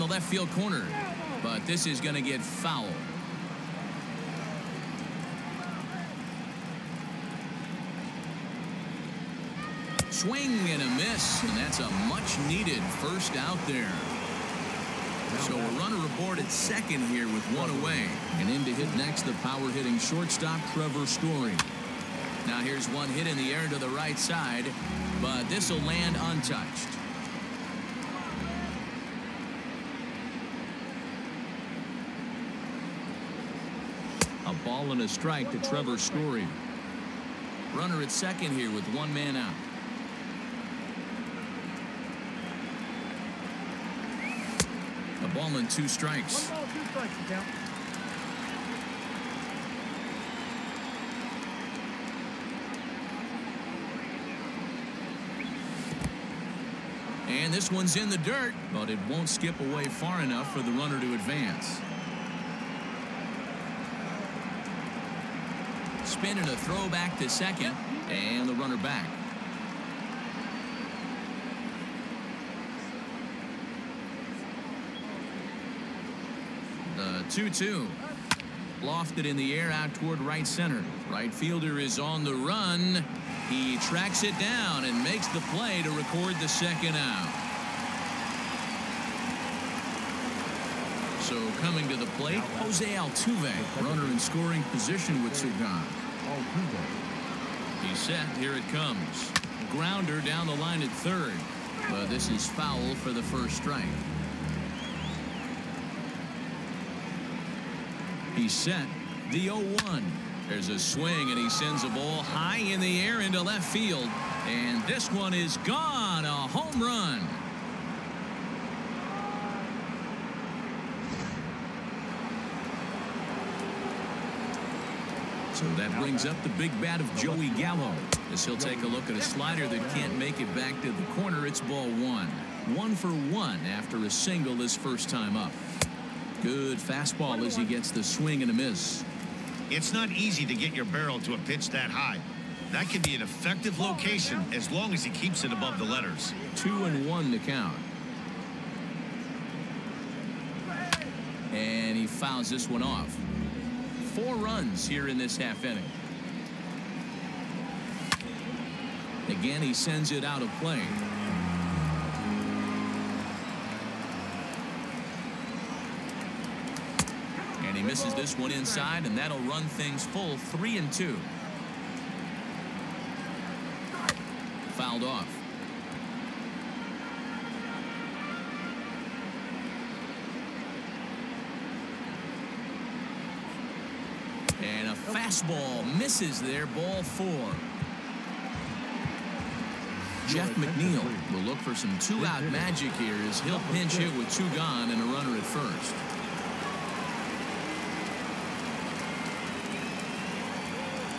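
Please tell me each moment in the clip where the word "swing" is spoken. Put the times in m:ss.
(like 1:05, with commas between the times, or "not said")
0:10, 1:50, 2:18.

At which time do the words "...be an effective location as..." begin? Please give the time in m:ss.
2:23.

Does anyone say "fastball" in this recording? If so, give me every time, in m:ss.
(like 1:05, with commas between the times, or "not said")
2:16, 3:05.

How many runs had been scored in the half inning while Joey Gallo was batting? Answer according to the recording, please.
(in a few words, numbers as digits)
4.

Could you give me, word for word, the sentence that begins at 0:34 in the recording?
A ball and a strike to Trevor Story.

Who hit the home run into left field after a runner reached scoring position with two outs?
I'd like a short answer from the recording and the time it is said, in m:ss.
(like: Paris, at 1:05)
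Jose Altuve, at 1:32.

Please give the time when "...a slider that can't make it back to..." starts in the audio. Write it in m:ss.
2:09.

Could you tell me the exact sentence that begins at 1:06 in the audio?
Spin and a throw back to second, and the runner back.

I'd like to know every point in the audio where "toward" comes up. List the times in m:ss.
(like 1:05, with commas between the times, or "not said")
1:19.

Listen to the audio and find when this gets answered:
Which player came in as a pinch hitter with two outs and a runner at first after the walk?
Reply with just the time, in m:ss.
3:10.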